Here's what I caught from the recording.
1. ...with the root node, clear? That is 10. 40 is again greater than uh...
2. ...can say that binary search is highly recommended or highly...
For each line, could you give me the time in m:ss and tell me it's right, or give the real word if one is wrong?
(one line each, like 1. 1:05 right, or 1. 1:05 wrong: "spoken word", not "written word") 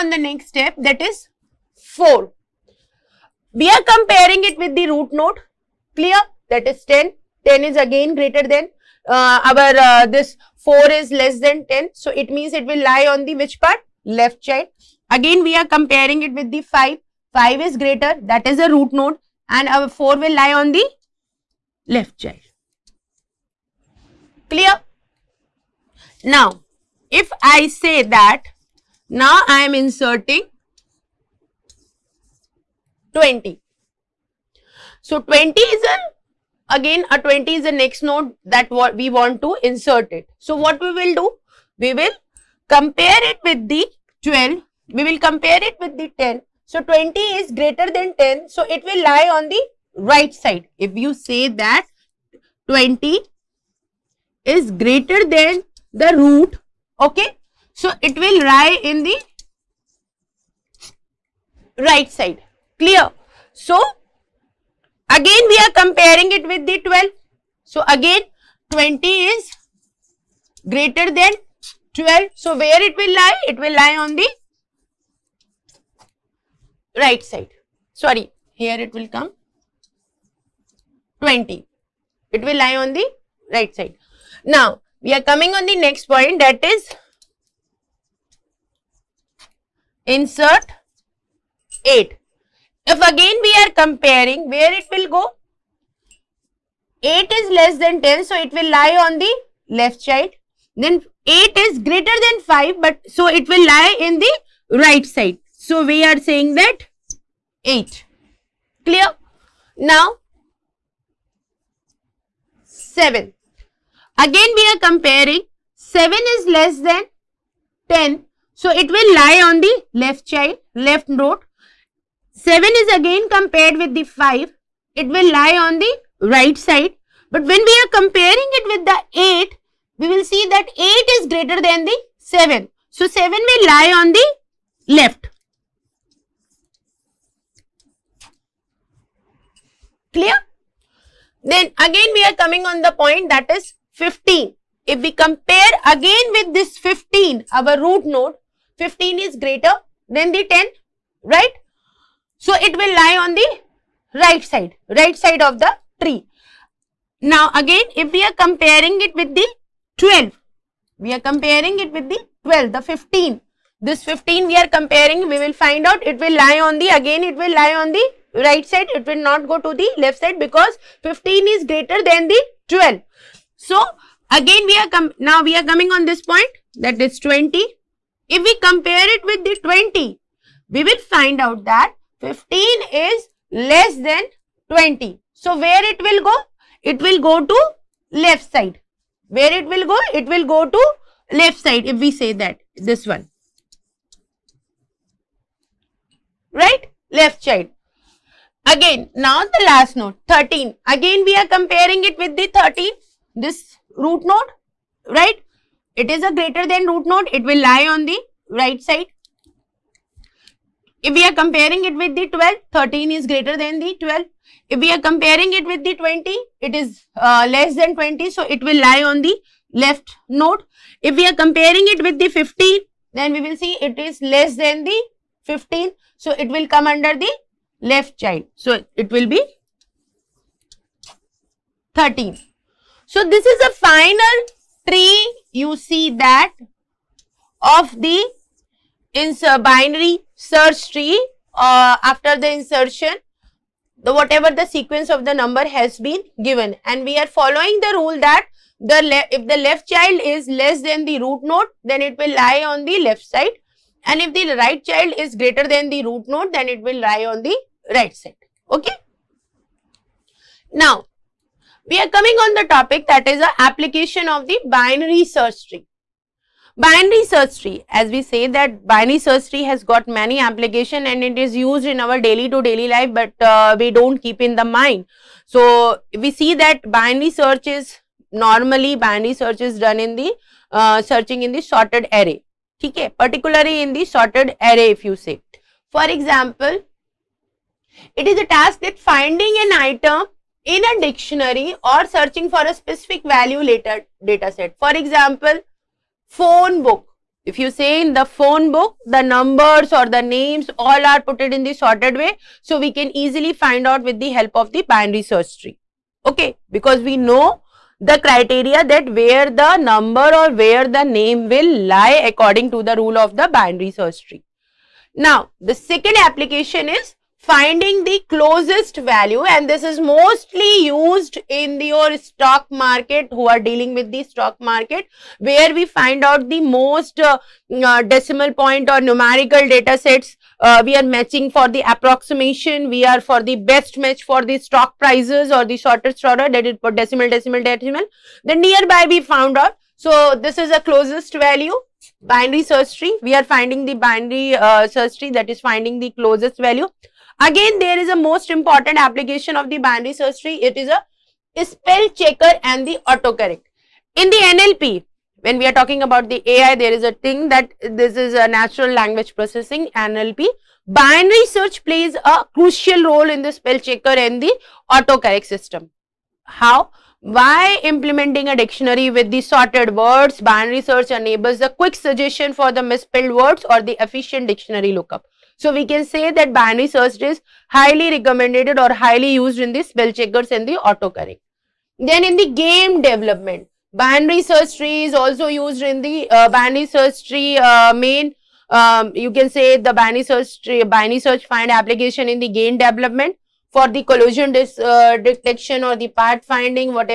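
1. 0:04 wrong: "10", not "40"
2. 6:15 right.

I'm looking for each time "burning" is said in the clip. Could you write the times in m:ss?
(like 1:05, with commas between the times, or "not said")
not said.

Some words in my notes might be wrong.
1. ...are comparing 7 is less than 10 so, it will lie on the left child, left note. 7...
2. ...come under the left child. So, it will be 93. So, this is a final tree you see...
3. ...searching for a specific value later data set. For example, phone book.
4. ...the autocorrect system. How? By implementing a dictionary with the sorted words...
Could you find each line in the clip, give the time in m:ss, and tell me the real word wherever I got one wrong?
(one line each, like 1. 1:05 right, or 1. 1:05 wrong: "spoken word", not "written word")
1. 1:54 right
2. 3:46 wrong: "13", not "93"
3. 4:52 right
4. 6:04 right.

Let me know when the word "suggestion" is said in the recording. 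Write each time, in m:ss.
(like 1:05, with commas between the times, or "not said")
6:11.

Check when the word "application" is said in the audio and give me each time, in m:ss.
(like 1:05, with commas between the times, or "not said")
4:23, 4:30, 5:16, 5:48, 6:31.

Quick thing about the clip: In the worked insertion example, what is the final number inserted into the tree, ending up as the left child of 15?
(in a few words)
13.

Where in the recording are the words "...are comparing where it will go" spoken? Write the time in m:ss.
1:33.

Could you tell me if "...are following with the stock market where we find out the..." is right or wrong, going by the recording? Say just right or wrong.
wrong.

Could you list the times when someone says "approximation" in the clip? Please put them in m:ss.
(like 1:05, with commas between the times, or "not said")
5:31.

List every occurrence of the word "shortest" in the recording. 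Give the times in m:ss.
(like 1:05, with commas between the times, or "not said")
5:35.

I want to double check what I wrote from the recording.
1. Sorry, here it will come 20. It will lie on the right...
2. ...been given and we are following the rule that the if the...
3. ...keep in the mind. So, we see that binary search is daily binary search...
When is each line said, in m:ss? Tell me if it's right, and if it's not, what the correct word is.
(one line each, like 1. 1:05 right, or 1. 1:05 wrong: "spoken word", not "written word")
1. 1:17 right
2. 4:06 right
3. 4:34 wrong: "normally", not "daily".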